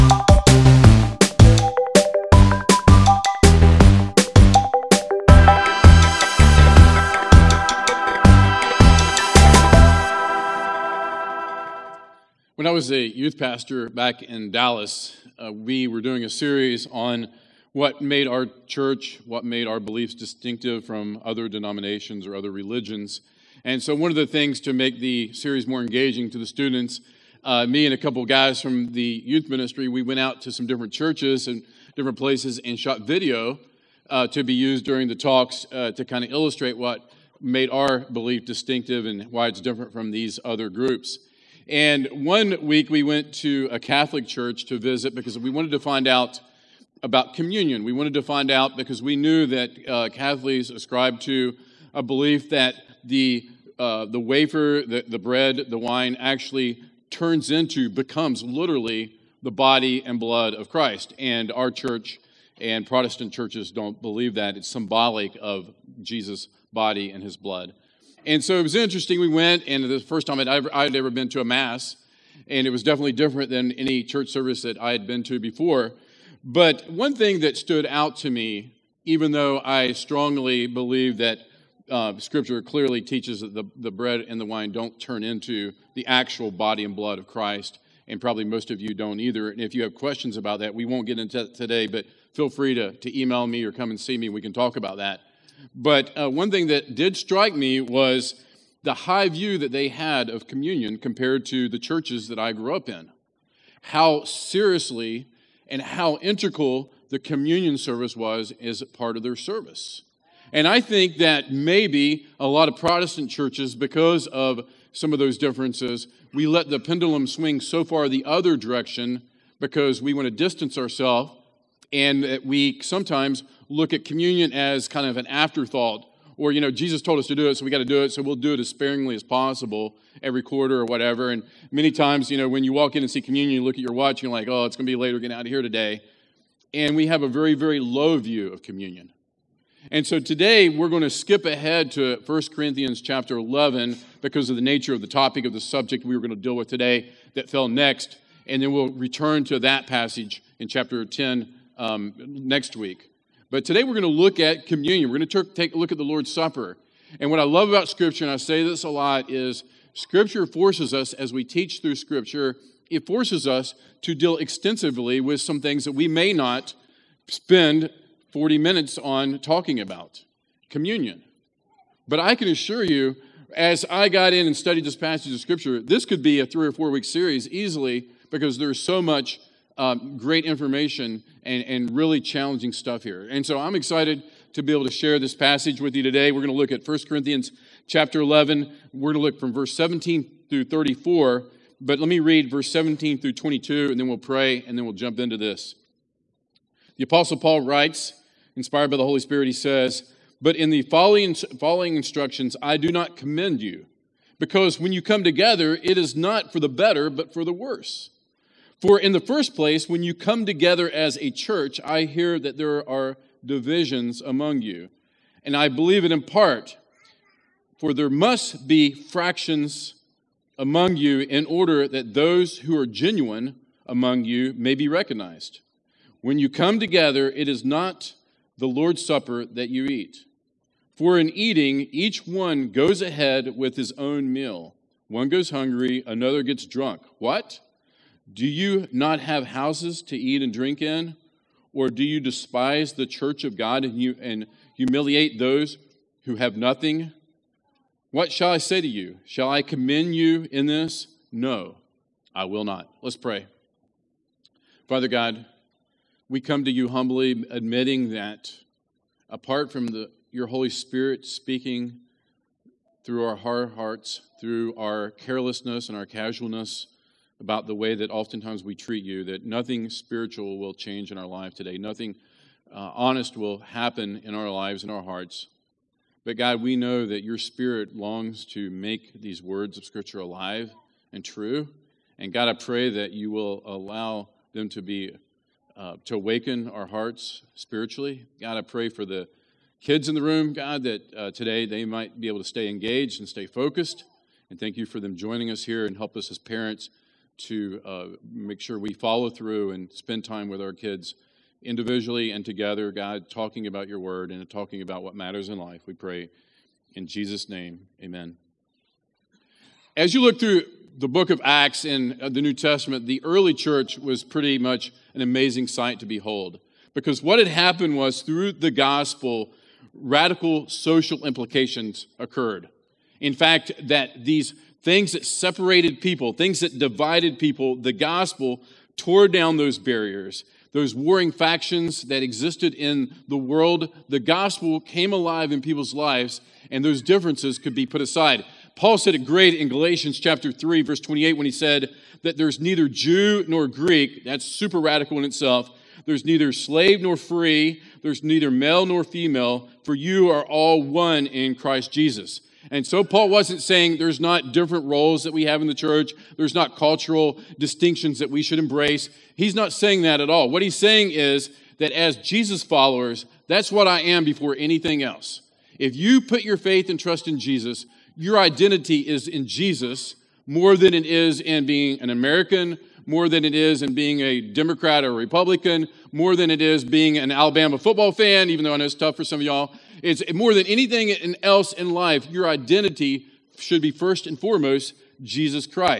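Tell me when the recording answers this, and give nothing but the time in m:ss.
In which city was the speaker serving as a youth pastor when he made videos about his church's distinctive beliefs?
0:14.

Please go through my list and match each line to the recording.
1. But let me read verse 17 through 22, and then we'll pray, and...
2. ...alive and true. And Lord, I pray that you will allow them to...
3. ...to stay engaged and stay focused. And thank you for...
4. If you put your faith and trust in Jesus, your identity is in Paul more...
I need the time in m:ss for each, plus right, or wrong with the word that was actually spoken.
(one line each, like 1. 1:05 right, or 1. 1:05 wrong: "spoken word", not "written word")
1. 3:11 right
2. 4:40 wrong: "God", not "Lord"
3. 4:52 right
4. 6:05 wrong: "Jesus", not "Paul".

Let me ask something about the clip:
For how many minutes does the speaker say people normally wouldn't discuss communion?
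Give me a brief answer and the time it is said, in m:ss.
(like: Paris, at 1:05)
40, at 2:48.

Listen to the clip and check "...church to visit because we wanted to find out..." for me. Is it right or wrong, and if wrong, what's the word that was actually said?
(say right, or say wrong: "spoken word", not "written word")
right.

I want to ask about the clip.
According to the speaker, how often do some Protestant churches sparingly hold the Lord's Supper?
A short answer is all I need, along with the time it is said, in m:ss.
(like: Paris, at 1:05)
Every quarter, at 2:10.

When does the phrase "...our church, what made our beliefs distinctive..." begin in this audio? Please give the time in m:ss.
0:18.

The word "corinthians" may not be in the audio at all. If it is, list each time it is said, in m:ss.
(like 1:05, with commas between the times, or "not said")
2:22, 3:07.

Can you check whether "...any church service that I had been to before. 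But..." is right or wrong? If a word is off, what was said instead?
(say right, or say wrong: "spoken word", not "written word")
right.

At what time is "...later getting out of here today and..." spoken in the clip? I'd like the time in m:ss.
2:14.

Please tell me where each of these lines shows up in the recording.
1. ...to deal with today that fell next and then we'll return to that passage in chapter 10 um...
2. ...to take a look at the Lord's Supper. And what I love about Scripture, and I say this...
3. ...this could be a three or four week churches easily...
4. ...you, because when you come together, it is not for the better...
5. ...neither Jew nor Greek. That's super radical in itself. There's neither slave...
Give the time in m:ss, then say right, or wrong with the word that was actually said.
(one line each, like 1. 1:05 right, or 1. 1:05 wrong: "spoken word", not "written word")
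1. 2:26 right
2. 2:35 right
3. 2:55 wrong: "series", not "churches"
4. 3:23 right
5. 5:42 right.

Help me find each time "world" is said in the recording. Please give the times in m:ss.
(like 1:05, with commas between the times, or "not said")
5:33.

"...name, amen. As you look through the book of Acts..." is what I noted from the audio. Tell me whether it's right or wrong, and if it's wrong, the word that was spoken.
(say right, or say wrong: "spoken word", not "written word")
right.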